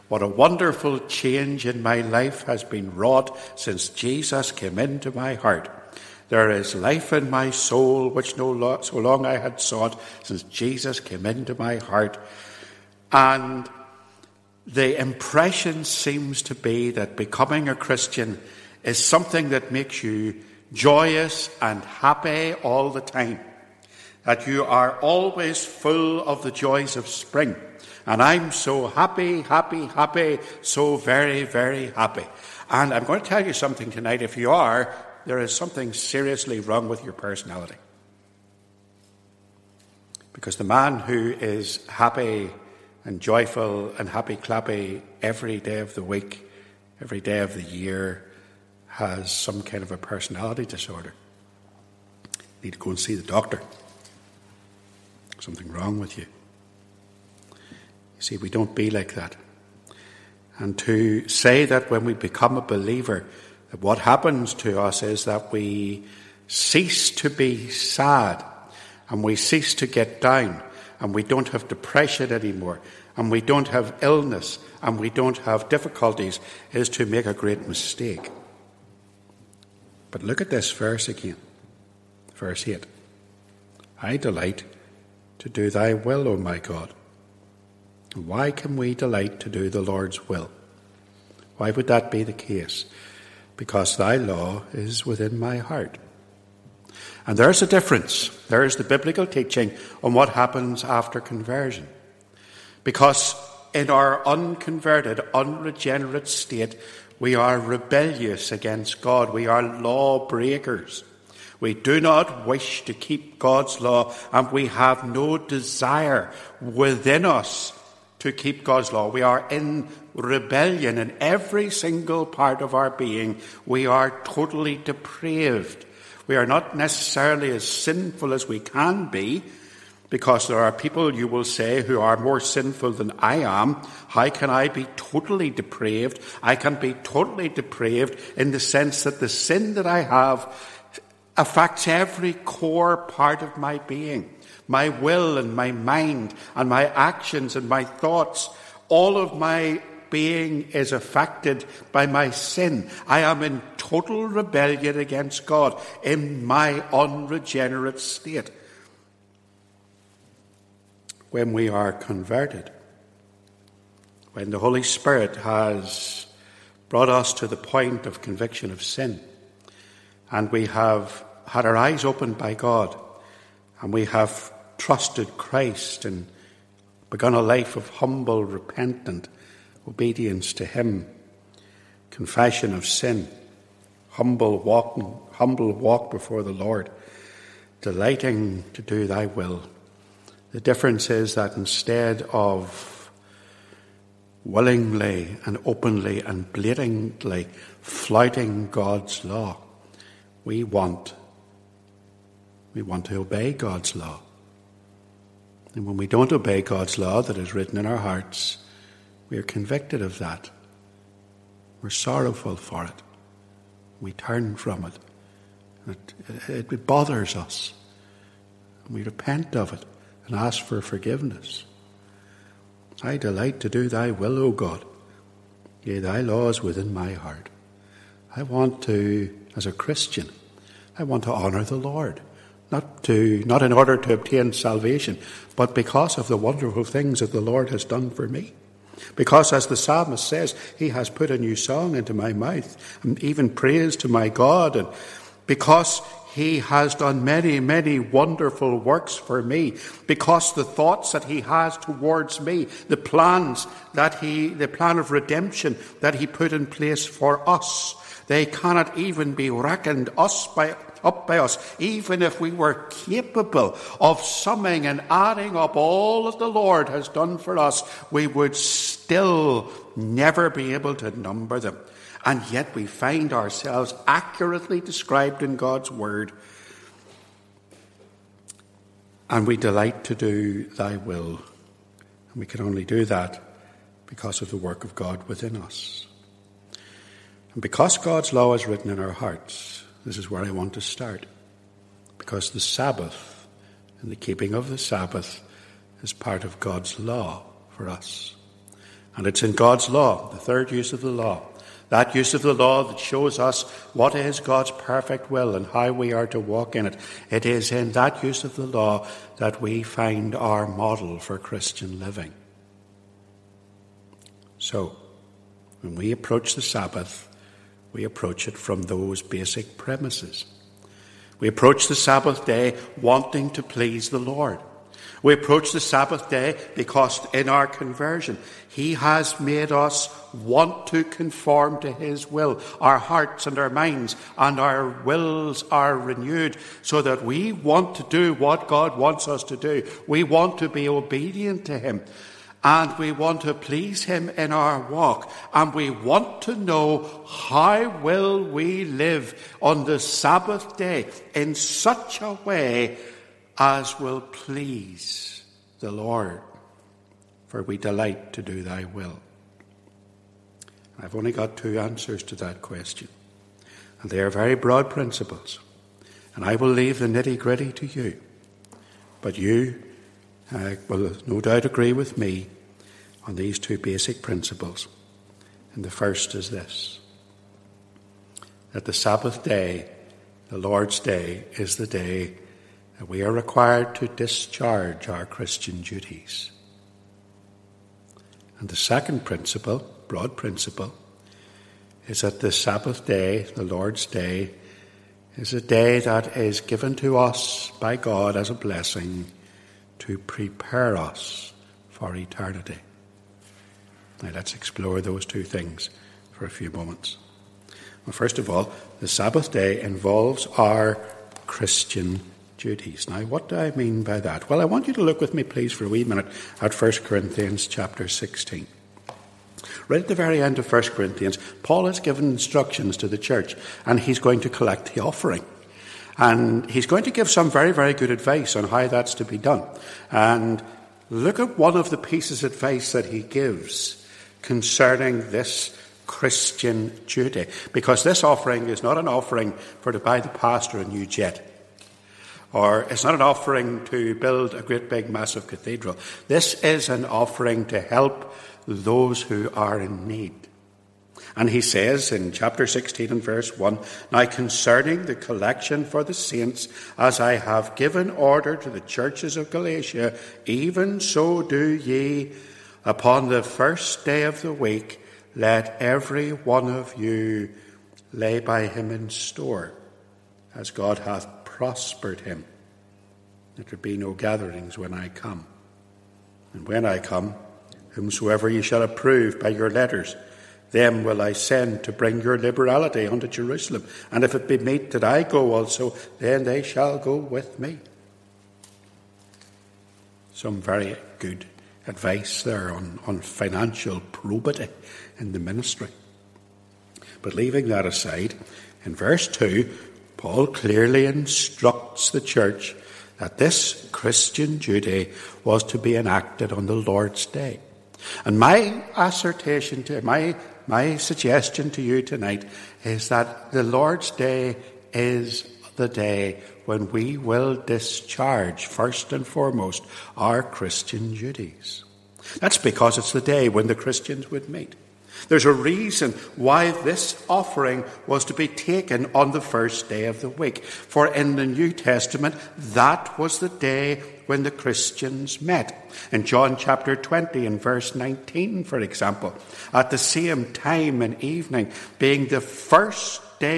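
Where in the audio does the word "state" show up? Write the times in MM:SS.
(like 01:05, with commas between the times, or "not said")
01:46, 02:37.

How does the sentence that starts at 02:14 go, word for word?
How can I be totally depraved?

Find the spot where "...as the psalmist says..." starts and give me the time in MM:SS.
03:59.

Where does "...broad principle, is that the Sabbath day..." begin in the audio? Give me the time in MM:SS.
06:30.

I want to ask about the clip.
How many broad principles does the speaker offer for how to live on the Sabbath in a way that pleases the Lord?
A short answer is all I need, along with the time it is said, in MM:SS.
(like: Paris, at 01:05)
2, at 06:01.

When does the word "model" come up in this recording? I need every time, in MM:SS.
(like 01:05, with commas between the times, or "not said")
05:10.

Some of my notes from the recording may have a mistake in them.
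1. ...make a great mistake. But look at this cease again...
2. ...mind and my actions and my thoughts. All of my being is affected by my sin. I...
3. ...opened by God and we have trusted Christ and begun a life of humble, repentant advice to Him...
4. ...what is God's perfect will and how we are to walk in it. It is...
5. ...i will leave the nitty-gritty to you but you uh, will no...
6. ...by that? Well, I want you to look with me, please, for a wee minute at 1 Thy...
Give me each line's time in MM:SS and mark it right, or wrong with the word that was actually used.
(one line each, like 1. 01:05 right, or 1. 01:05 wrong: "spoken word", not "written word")
1. 01:17 wrong: "verse", not "cease"
2. 02:25 right
3. 02:52 wrong: "obedience", not "advice"
4. 05:03 right
5. 06:06 right
6. 06:54 wrong: "Corinthians", not "Thy".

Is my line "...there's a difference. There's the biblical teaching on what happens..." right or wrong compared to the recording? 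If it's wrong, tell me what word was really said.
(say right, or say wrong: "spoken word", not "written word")
right.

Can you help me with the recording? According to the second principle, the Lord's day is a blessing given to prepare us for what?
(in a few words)
Eternity.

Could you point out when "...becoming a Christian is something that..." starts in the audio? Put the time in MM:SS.
00:17.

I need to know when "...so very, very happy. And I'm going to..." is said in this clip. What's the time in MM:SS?
00:30.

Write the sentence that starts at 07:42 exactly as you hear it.
Upon the first day of the week, let every one of you lay by him in store, as God hath prospered him.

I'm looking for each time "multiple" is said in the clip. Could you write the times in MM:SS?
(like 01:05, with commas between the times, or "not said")
not said.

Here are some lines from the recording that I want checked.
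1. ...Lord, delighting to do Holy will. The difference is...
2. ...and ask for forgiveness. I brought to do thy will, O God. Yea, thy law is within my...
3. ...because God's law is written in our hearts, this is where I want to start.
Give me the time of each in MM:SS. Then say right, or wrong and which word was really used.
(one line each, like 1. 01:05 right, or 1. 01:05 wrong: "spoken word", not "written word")
1. 03:06 wrong: "Thy", not "Holy"
2. 03:40 wrong: "delight", not "brought"
3. 04:47 right.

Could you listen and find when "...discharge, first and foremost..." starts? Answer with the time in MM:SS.
08:37.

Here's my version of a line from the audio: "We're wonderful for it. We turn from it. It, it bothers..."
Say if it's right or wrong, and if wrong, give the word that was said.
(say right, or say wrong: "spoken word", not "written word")
wrong: "sorrowful", not "wonderful".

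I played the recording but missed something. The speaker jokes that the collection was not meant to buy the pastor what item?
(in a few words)
A new jet.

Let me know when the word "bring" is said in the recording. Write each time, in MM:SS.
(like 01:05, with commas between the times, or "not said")
08:01.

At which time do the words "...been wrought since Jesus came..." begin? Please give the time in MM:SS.
00:02.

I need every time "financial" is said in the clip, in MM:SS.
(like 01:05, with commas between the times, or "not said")
08:13.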